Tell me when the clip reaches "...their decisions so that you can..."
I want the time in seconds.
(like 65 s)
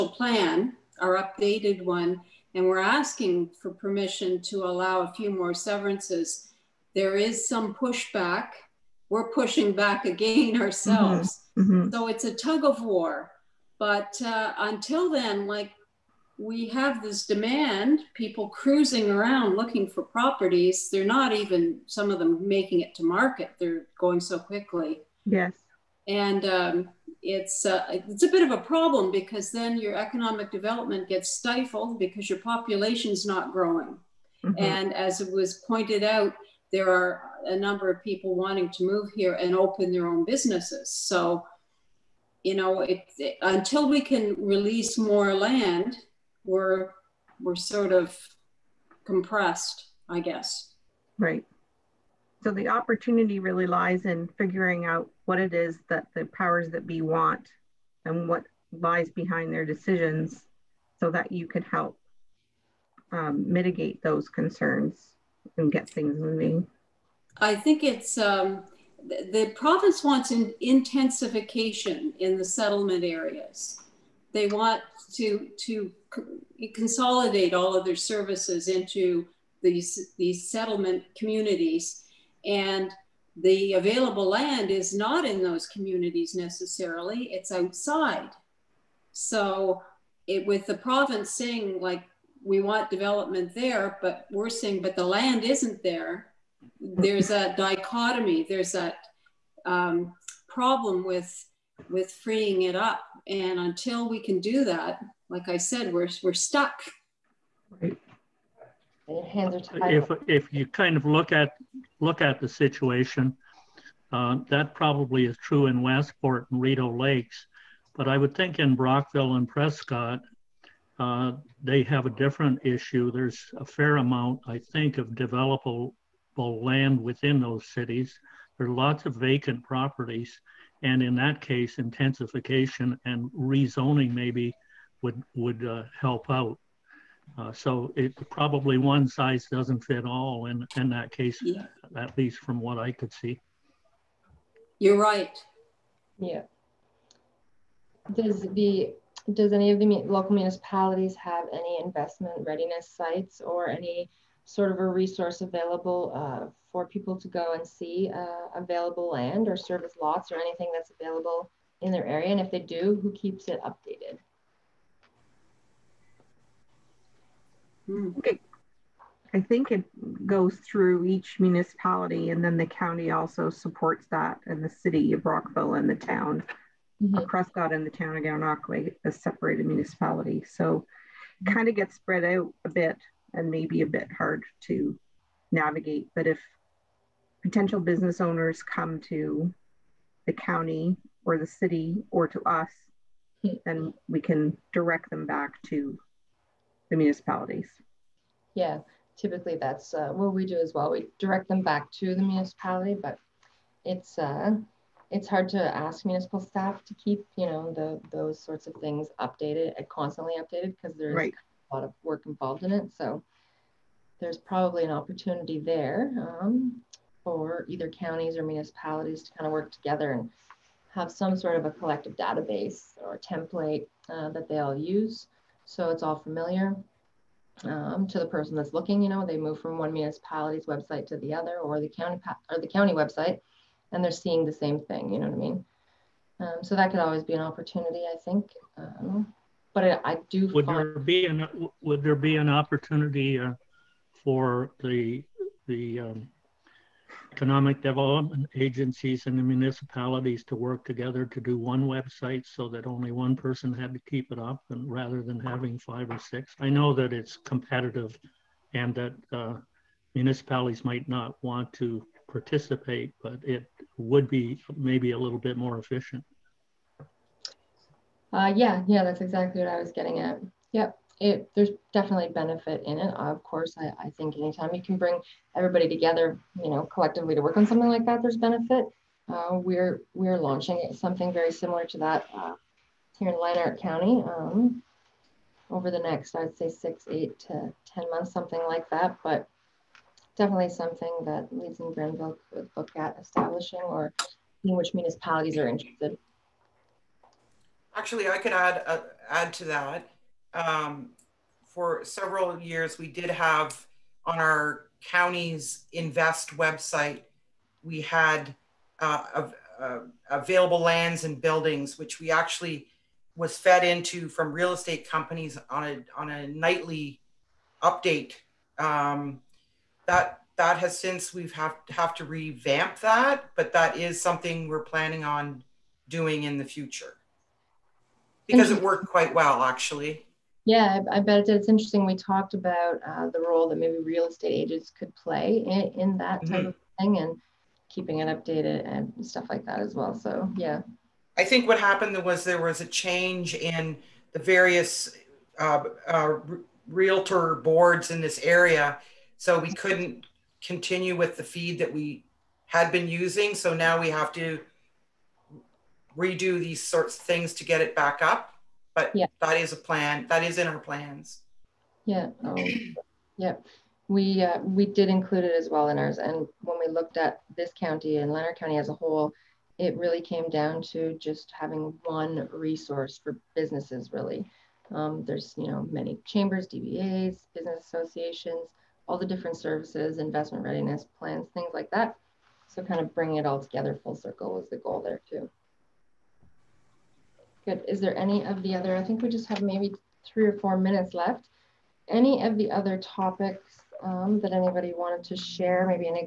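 59 s.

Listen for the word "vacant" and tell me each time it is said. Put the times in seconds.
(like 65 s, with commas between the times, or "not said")
129 s.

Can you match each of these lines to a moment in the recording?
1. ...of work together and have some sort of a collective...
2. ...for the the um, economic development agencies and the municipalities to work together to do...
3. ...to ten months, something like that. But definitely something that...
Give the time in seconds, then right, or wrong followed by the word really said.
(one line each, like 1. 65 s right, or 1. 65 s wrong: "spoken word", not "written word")
1. 219 s right
2. 244 s right
3. 287 s right.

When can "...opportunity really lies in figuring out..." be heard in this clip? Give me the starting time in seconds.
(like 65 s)
52 s.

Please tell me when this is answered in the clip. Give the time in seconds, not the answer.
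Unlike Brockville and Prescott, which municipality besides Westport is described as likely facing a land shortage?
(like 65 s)
116 s.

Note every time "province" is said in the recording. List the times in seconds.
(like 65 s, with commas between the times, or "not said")
69 s, 90 s.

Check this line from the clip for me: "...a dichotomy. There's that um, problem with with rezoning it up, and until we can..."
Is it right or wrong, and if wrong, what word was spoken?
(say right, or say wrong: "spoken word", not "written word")
wrong: "freeing", not "rezoning".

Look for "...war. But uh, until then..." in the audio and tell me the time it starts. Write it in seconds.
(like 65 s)
12 s.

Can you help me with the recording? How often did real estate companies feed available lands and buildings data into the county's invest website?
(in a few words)
Nightly.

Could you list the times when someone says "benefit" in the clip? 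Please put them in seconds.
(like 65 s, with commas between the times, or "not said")
272 s, 278 s.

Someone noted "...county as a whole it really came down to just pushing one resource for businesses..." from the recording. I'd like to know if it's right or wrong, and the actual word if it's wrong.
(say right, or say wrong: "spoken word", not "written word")
wrong: "having", not "pushing".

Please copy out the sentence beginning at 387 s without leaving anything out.
Is there any of the other, I think we just have maybe three or four minutes left.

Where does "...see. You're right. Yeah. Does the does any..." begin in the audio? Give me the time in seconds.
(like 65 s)
143 s.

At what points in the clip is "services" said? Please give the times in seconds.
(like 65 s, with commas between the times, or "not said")
77 s, 159 s, 379 s.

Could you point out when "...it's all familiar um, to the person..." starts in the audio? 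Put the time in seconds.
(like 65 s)
225 s.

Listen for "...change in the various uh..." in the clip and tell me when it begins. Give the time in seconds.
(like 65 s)
342 s.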